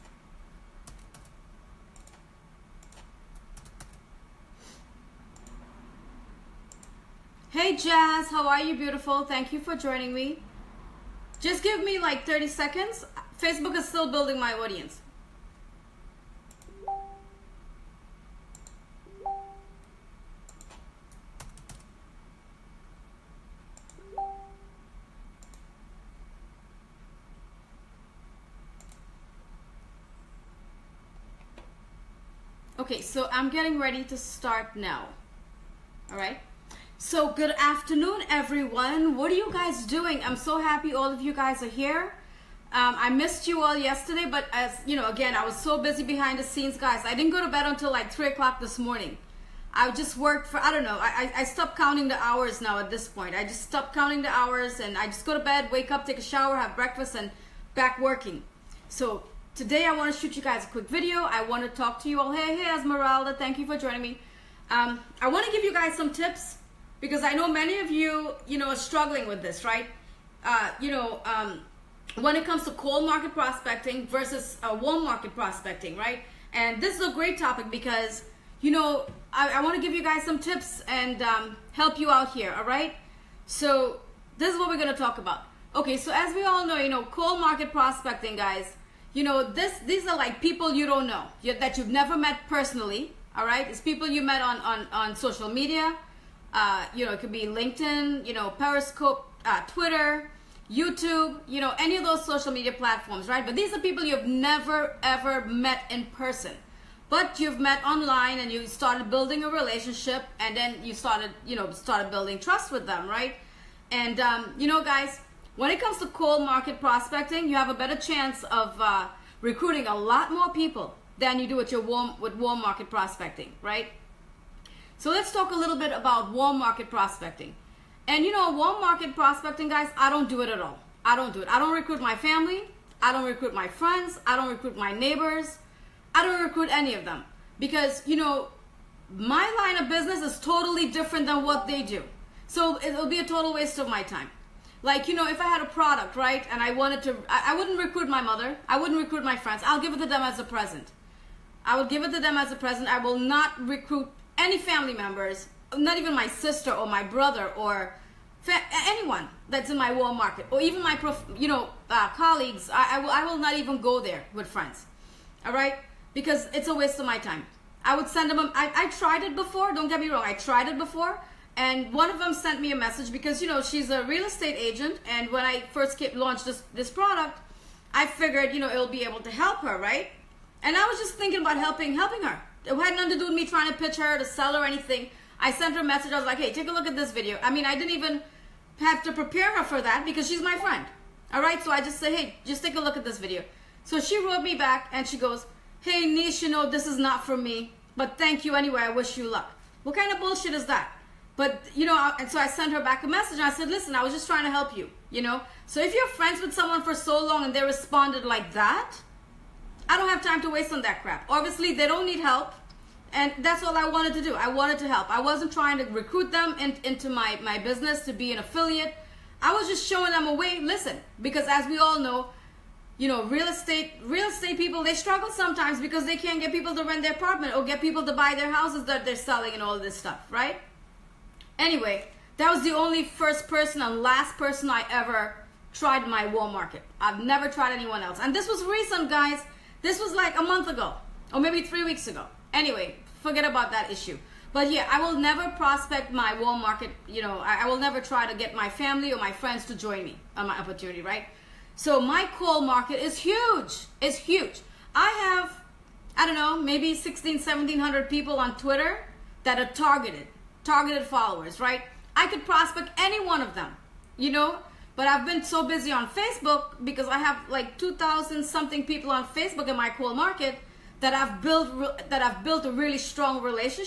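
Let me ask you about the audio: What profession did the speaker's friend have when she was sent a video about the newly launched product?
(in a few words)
Real estate agent.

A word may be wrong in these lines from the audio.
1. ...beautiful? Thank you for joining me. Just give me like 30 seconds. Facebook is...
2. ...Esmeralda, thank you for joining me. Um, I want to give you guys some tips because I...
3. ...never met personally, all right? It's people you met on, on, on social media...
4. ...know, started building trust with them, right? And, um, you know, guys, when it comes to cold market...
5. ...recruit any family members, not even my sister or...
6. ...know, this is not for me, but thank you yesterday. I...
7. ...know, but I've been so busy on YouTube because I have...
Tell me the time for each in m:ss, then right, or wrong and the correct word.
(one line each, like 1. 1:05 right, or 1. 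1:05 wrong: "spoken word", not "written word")
1. 0:08 right
2. 1:02 right
3. 1:31 right
4. 1:51 right
5. 2:33 right
6. 3:16 wrong: "anyway", not "yesterday"
7. 4:24 wrong: "Facebook", not "YouTube".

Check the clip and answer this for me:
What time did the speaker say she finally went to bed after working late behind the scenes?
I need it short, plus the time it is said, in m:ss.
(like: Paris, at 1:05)
3 o'clock, at 0:48.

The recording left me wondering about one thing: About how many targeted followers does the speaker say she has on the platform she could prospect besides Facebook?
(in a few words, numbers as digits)
1,700.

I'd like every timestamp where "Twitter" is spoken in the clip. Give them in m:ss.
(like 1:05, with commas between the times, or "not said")
1:39, 4:18.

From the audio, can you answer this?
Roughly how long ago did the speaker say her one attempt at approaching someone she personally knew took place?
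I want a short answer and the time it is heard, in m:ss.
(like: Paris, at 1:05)
A month ago, at 4:00.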